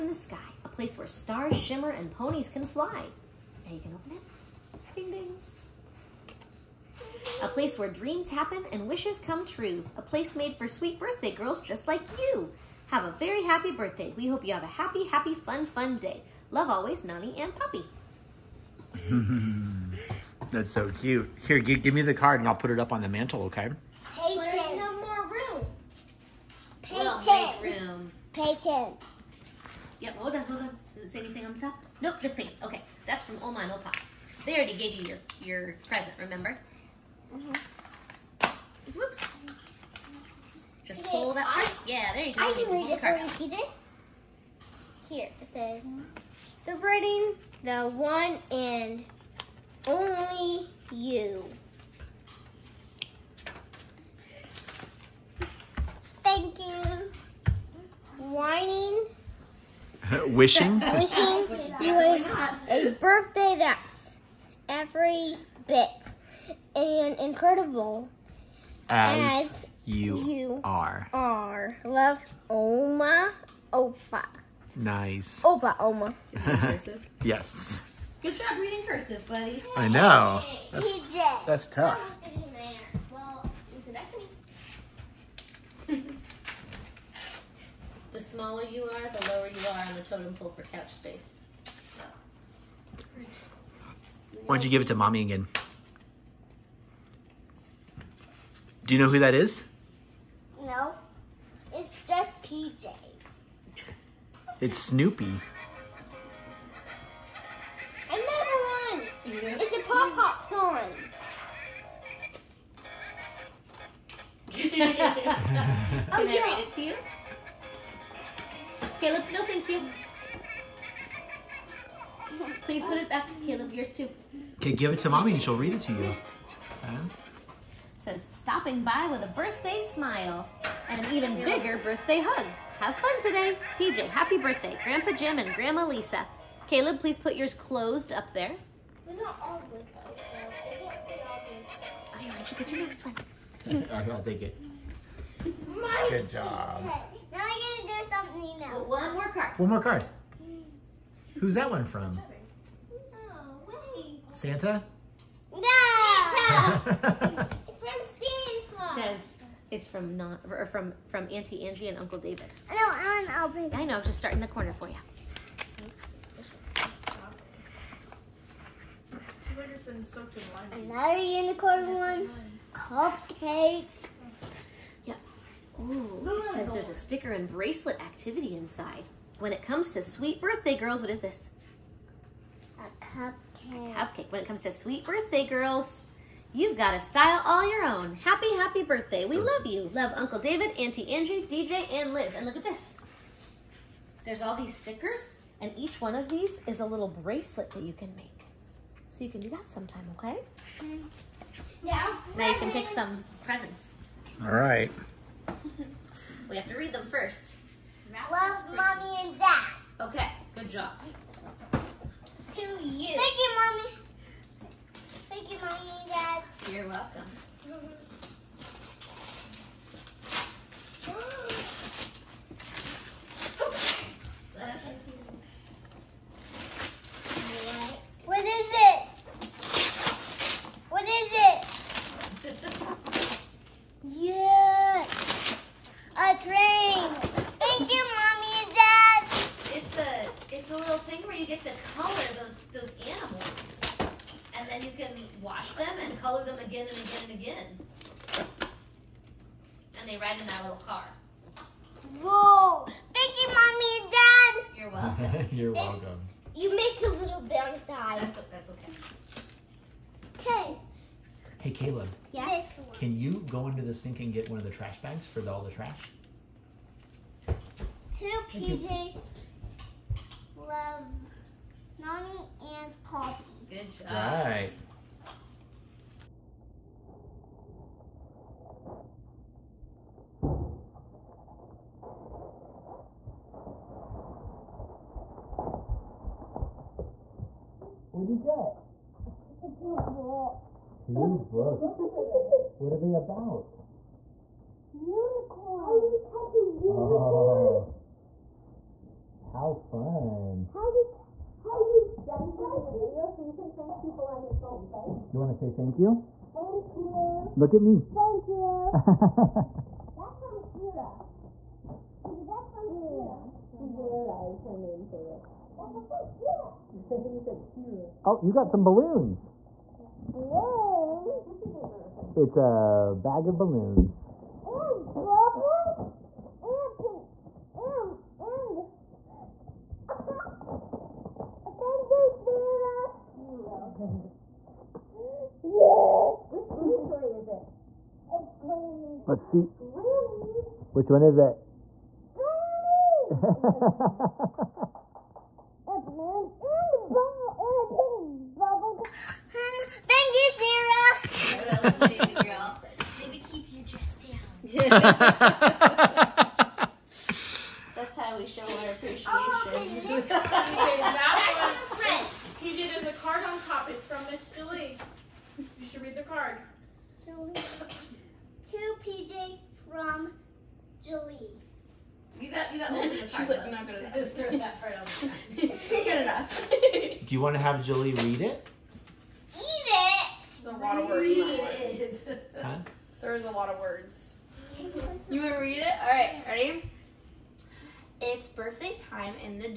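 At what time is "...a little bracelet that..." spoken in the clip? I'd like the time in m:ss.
3:16.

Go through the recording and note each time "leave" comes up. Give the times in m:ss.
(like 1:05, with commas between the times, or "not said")
not said.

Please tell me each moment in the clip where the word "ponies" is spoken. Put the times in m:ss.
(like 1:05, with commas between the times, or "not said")
0:02.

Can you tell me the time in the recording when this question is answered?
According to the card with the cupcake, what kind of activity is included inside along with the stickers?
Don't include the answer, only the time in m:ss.
2:57.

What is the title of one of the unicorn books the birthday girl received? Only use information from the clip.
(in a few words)
How Do You Catch a Unicorn?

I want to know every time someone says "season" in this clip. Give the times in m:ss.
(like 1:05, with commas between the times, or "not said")
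not said.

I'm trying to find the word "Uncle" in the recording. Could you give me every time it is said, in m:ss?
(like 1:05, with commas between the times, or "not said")
2:41, 3:10.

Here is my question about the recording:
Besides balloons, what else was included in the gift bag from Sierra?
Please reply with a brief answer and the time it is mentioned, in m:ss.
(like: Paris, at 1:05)
Bubbles, at 5:24.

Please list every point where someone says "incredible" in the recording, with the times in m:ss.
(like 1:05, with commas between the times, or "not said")
1:07.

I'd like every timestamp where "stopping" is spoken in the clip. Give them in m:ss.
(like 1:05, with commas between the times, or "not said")
2:08.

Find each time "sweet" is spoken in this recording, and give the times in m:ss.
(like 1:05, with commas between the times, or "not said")
0:10, 3:00, 3:04.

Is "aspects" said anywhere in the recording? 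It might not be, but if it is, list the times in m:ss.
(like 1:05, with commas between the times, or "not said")
not said.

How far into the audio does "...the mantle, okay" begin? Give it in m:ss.
0:23.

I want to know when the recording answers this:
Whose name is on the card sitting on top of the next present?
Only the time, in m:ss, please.
6:04.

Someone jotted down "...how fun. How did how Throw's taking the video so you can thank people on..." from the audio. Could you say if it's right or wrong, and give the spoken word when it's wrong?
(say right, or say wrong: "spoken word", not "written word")
wrong: "Daddy", not "Throw".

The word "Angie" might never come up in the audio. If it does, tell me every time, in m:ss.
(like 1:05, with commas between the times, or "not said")
2:41, 3:11.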